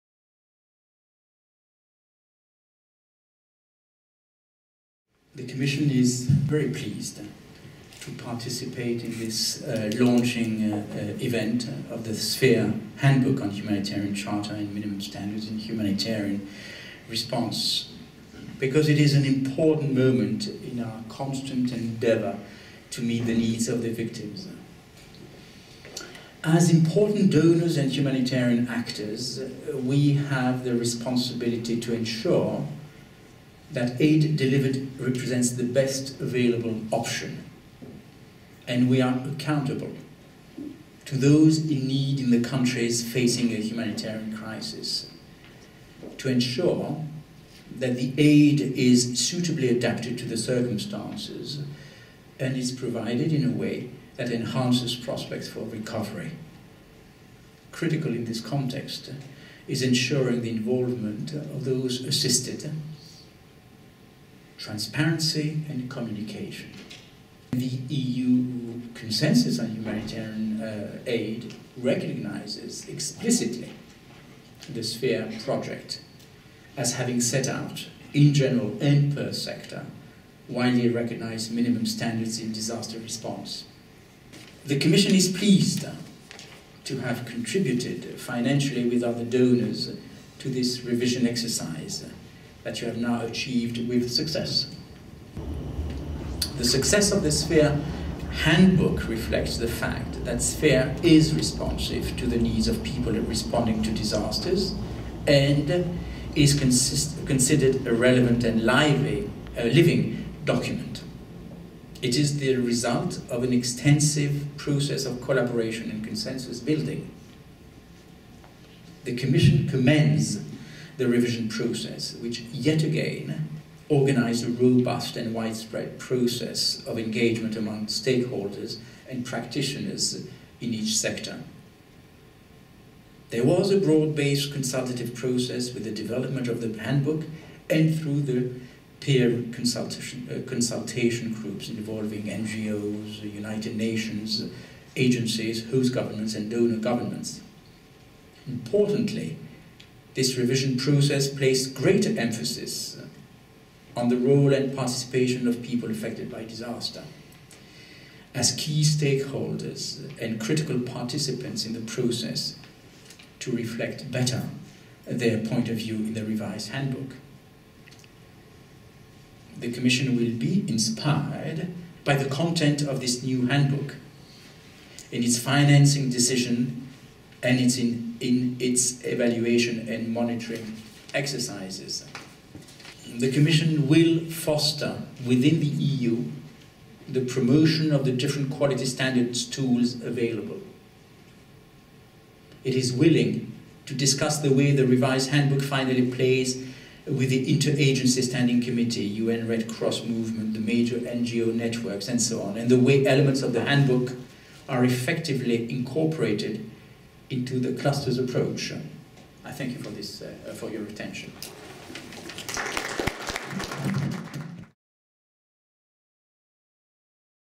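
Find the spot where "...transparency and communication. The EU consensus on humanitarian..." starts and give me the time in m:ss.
1:04.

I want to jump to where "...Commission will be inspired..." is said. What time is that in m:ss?
2:49.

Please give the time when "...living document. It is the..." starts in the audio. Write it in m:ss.
1:49.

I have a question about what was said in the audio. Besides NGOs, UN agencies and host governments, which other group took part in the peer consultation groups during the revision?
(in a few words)
donor governments.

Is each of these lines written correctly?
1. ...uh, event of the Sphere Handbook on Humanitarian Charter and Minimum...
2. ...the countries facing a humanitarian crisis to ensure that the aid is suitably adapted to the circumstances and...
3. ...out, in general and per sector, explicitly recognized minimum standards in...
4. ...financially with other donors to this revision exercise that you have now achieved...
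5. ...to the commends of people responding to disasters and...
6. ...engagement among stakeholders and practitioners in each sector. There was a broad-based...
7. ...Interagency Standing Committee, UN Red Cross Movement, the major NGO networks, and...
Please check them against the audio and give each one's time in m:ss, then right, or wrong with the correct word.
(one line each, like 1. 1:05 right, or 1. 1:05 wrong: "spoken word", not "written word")
1. 0:10 right
2. 0:42 right
3. 1:17 wrong: "widely", not "explicitly"
4. 1:28 right
5. 1:42 wrong: "needs", not "commends"
6. 2:06 right
7. 3:17 right.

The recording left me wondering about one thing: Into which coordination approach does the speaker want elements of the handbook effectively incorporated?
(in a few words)
the clusters approach.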